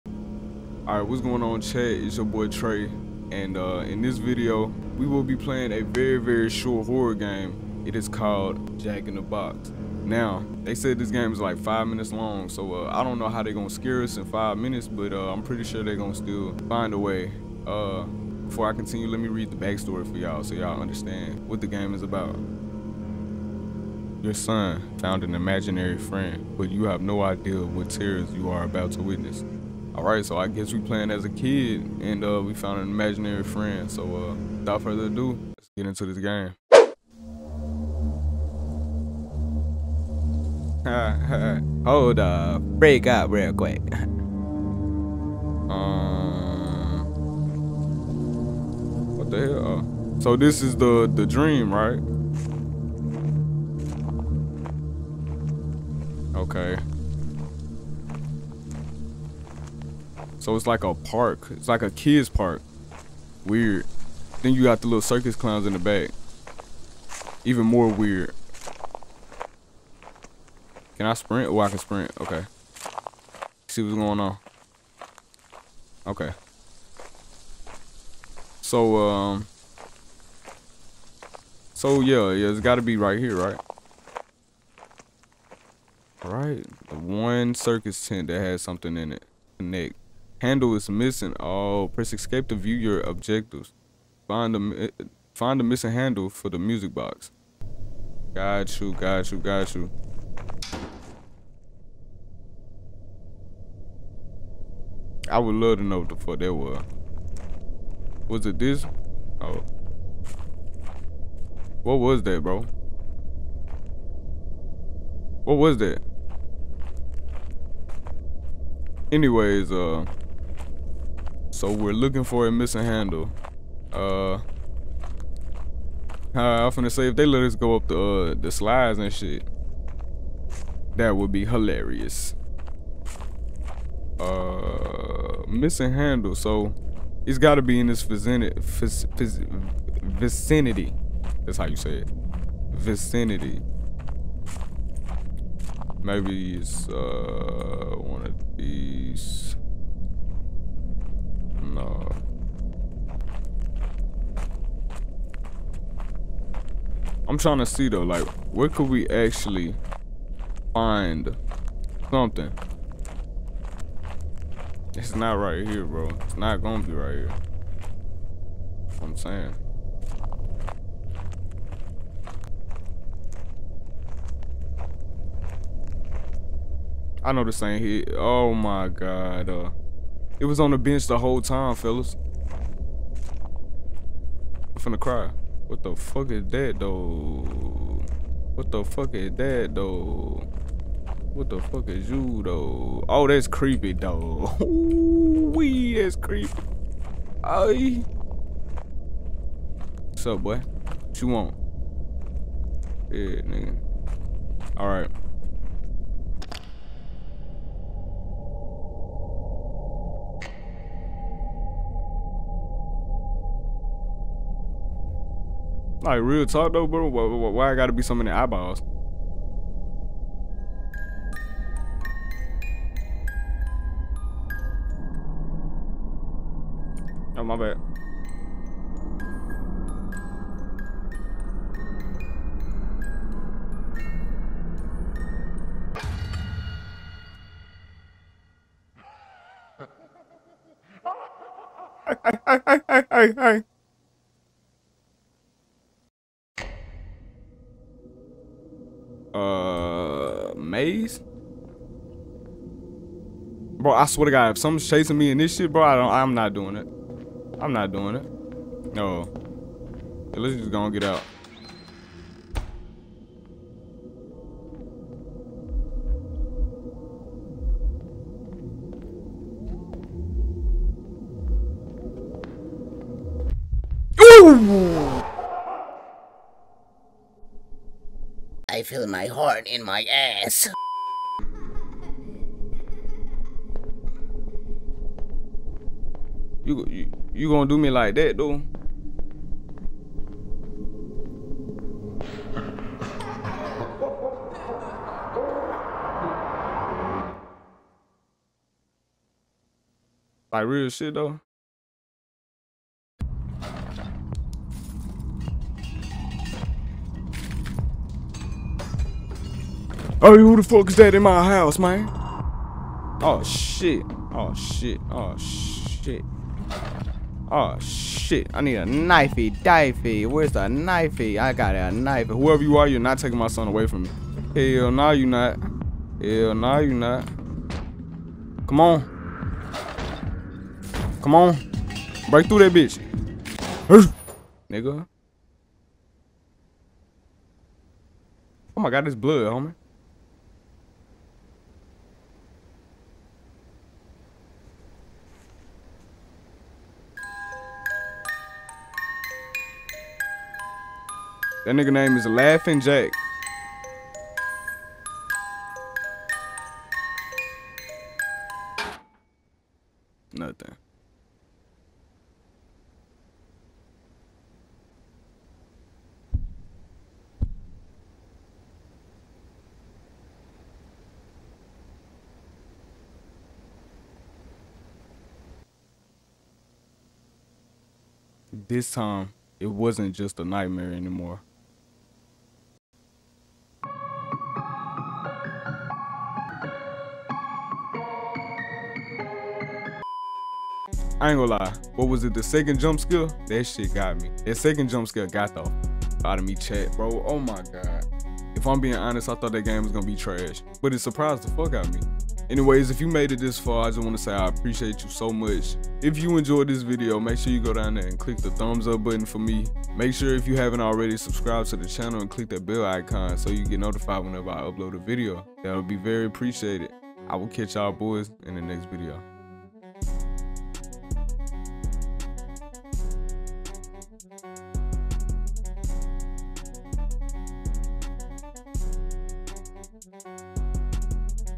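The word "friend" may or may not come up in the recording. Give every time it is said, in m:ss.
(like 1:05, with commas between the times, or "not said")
0:25, 0:33.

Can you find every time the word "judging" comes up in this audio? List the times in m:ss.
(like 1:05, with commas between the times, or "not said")
not said.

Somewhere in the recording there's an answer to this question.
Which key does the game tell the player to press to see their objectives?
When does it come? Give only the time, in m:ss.
1:32.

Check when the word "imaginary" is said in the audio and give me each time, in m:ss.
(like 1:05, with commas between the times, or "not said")
0:25, 0:32.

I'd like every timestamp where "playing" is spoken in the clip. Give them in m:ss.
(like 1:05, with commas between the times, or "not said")
0:05, 0:30.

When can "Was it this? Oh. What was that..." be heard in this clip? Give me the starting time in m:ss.
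1:48.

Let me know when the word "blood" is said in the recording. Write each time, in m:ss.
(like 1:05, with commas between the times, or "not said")
5:39.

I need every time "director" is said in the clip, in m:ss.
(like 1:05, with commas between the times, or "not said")
not said.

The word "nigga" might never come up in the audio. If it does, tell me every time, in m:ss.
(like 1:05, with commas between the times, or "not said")
3:23, 5:34, 5:51.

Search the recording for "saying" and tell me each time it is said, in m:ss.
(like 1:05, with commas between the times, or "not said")
2:49.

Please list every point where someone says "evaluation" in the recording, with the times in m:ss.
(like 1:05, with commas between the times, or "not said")
not said.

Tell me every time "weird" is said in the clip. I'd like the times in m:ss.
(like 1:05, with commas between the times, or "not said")
1:03, 1:07.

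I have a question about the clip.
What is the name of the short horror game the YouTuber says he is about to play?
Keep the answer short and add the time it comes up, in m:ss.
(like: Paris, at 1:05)
Jack in the Box, at 0:08.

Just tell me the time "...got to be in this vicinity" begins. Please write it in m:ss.
2:17.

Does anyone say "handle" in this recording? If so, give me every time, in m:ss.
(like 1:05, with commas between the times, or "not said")
1:30, 1:35, 2:02, 2:15.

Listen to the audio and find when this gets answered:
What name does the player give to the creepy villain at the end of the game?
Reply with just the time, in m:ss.
5:52.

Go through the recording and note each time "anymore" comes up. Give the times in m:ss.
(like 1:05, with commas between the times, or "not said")
6:20.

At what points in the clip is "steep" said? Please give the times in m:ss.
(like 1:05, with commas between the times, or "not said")
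not said.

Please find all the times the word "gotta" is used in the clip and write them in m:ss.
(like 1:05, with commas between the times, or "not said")
1:22, 3:37.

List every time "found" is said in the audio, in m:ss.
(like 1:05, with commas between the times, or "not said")
0:24, 0:32.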